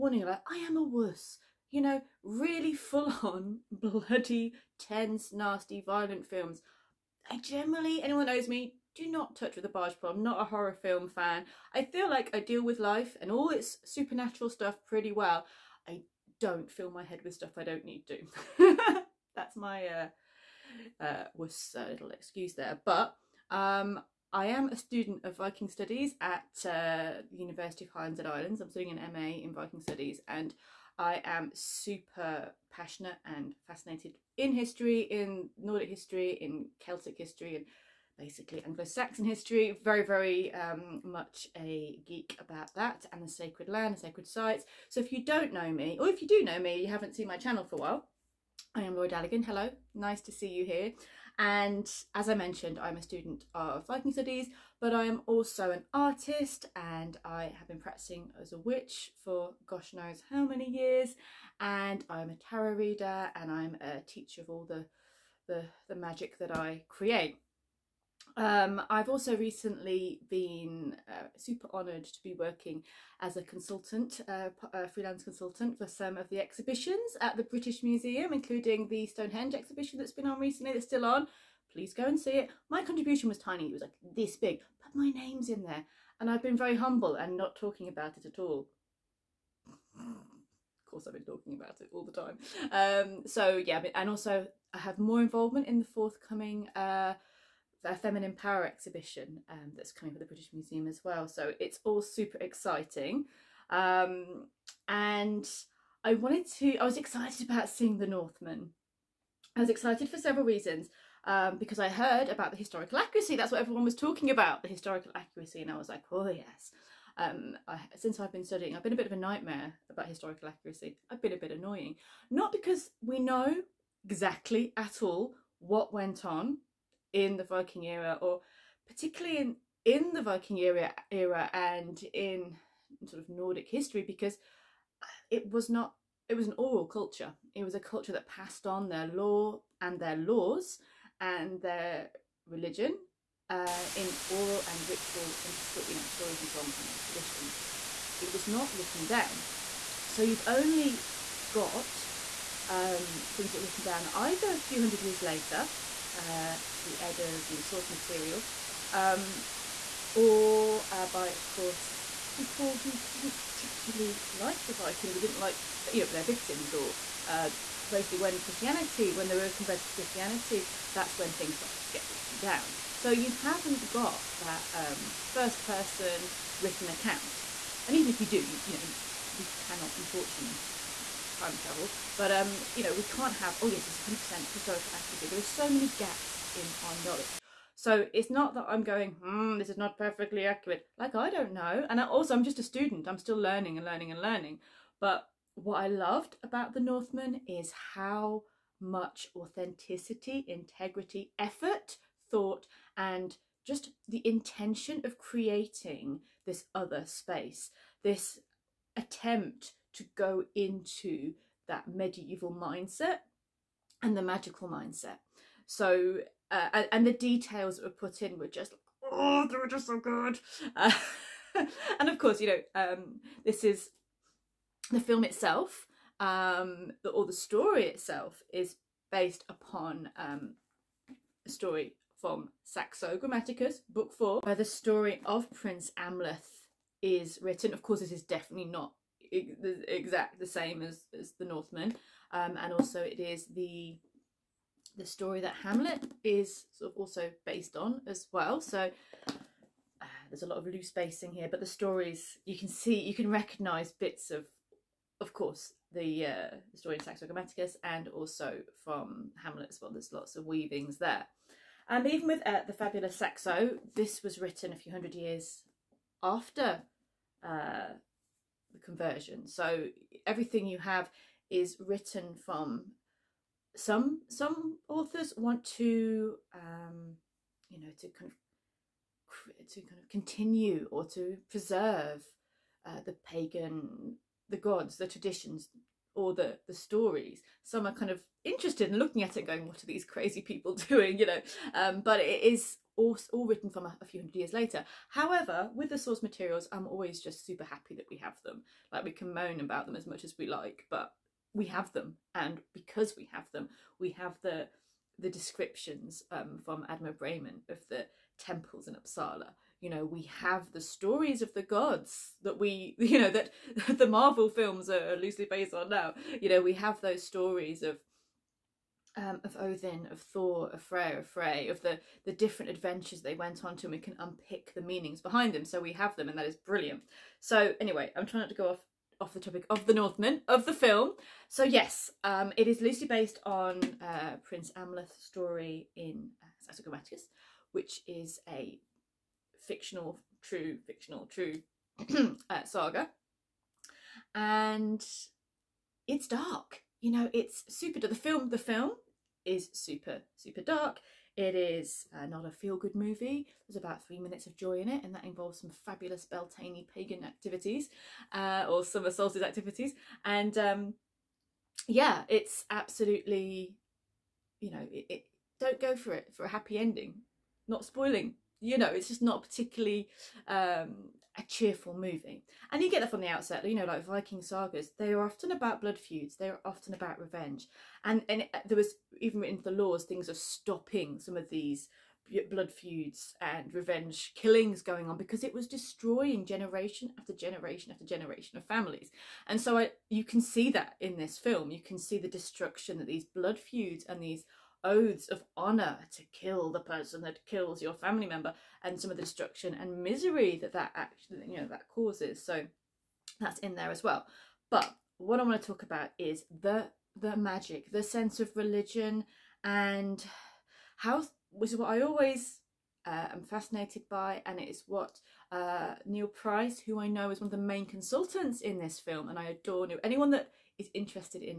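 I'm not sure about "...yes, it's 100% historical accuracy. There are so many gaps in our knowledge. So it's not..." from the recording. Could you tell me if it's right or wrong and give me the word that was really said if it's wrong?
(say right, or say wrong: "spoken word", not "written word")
right.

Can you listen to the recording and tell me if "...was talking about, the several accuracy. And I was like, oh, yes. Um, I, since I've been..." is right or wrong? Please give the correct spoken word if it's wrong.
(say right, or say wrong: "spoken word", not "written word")
wrong: "historical", not "several".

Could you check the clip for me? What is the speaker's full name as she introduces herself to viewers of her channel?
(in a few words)
Laura Daligan.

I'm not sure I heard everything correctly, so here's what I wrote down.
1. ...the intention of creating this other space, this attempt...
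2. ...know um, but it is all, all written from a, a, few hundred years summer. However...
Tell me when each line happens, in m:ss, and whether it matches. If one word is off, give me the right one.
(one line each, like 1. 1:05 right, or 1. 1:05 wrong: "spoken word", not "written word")
1. 3:24 right
2. 4:51 wrong: "later", not "summer".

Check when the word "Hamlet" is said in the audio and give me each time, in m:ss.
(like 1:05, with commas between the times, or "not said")
4:05, 4:19.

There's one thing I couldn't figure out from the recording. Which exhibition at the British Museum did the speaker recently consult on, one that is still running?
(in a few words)
Stonehenge.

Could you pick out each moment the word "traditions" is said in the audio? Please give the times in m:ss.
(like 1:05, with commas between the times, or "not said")
2:27, 4:45.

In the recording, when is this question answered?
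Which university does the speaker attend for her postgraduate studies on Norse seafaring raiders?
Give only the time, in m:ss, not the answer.
0:27.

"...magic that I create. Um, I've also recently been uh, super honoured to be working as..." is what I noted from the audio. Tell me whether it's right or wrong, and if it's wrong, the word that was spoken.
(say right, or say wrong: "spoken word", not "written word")
right.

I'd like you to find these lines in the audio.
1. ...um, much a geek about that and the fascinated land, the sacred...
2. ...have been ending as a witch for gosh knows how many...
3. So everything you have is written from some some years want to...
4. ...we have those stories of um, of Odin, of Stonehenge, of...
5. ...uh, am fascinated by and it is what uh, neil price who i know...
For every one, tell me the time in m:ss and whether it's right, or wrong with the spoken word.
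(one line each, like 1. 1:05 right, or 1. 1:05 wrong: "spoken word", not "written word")
1. 0:40 wrong: "sacred", not "fascinated"
2. 0:57 wrong: "practicing", not "ending"
3. 4:29 wrong: "authors", not "years"
4. 5:16 wrong: "Thor", not "Stonehenge"
5. 6:53 right.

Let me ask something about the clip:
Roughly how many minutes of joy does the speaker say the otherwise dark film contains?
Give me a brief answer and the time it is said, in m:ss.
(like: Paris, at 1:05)
3, at 5:54.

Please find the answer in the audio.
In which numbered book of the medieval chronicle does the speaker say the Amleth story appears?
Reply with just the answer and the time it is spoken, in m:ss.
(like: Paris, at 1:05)
4, at 3:54.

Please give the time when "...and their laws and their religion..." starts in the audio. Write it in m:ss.
2:19.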